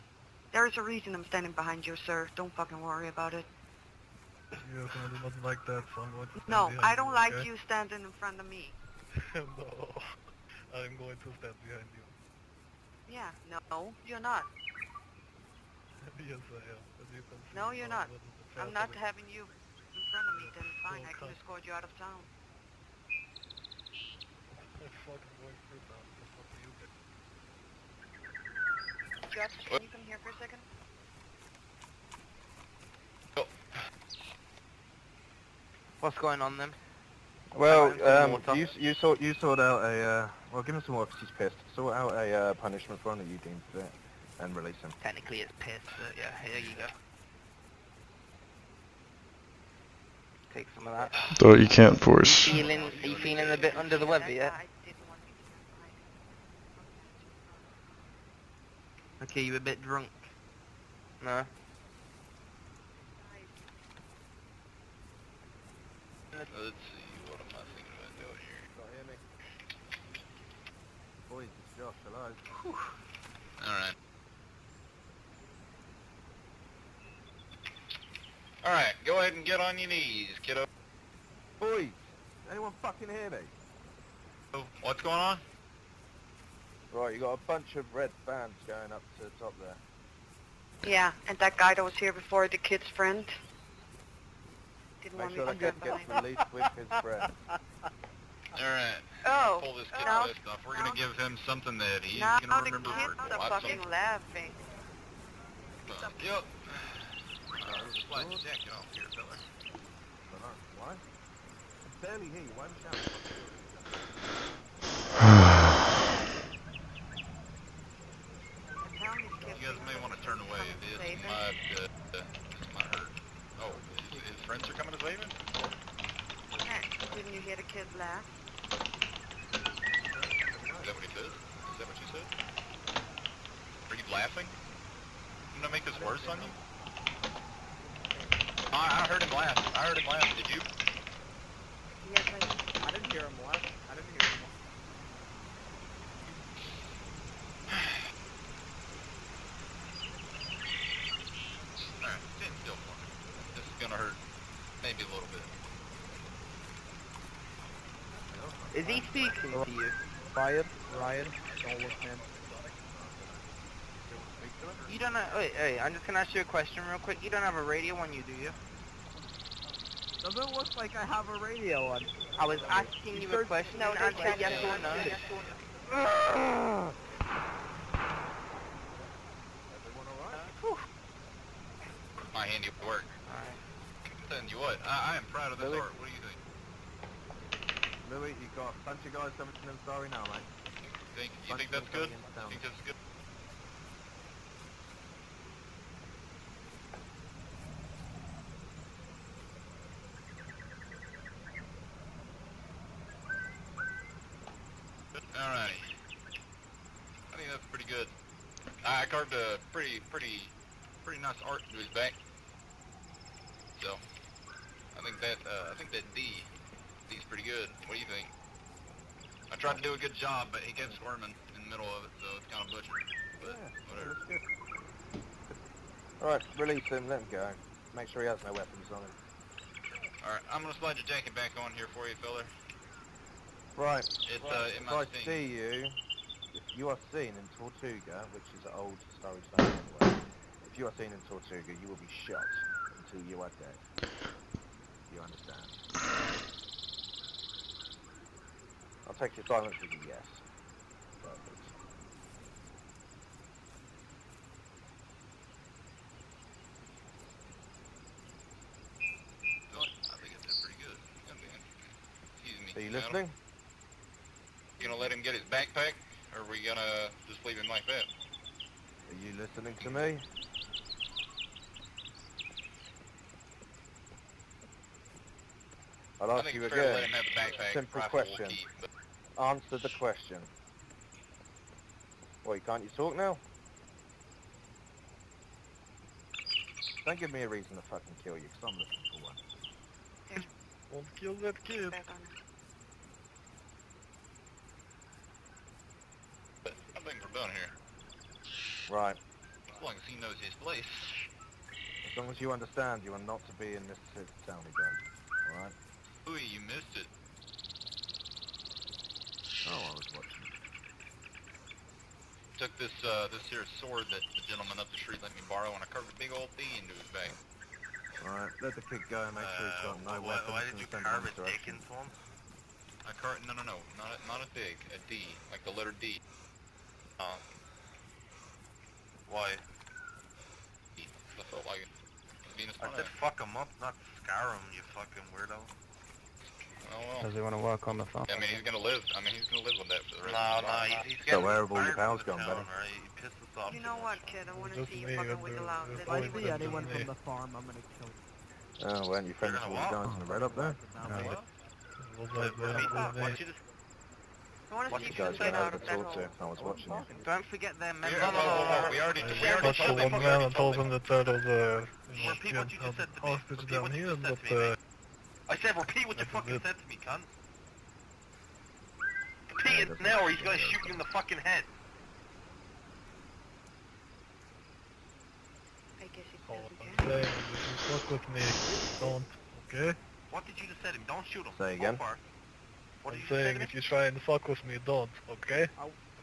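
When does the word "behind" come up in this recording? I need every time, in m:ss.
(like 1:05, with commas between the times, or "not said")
0:01, 0:11.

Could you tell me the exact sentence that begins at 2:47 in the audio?
You don't have a radio on you, do you?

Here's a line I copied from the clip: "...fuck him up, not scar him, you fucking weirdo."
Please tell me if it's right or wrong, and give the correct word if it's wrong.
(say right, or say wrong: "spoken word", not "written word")
right.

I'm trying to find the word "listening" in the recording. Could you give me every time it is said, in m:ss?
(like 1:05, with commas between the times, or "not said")
4:22, 4:29.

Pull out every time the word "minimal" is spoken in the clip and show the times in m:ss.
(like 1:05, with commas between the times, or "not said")
not said.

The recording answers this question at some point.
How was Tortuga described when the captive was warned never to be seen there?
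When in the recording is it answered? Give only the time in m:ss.
3:58.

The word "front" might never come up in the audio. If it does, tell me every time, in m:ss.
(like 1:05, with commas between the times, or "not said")
0:08, 0:20.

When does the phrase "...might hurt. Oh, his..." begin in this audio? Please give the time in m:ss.
2:02.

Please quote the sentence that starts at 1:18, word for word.
All right, go ahead and get on your knees, kiddo.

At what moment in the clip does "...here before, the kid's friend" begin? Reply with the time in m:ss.
1:31.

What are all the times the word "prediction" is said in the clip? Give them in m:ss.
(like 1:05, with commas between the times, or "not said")
not said.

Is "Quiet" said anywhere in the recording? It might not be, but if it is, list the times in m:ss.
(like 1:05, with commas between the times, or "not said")
2:40.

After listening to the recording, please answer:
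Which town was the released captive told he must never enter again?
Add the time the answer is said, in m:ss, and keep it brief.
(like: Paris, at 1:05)
Mississippi Town, at 5:03.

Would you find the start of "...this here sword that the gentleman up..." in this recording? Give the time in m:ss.
5:13.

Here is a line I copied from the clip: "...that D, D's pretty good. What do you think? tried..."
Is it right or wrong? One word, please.
right.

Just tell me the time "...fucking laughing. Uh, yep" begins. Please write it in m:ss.
1:43.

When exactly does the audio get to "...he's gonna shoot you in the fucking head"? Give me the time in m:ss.
6:10.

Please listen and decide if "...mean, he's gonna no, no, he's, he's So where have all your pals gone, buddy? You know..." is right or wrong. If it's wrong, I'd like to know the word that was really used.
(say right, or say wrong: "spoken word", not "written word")
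right.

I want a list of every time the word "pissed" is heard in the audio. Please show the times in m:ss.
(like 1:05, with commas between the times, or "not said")
0:41, 0:45, 1:40.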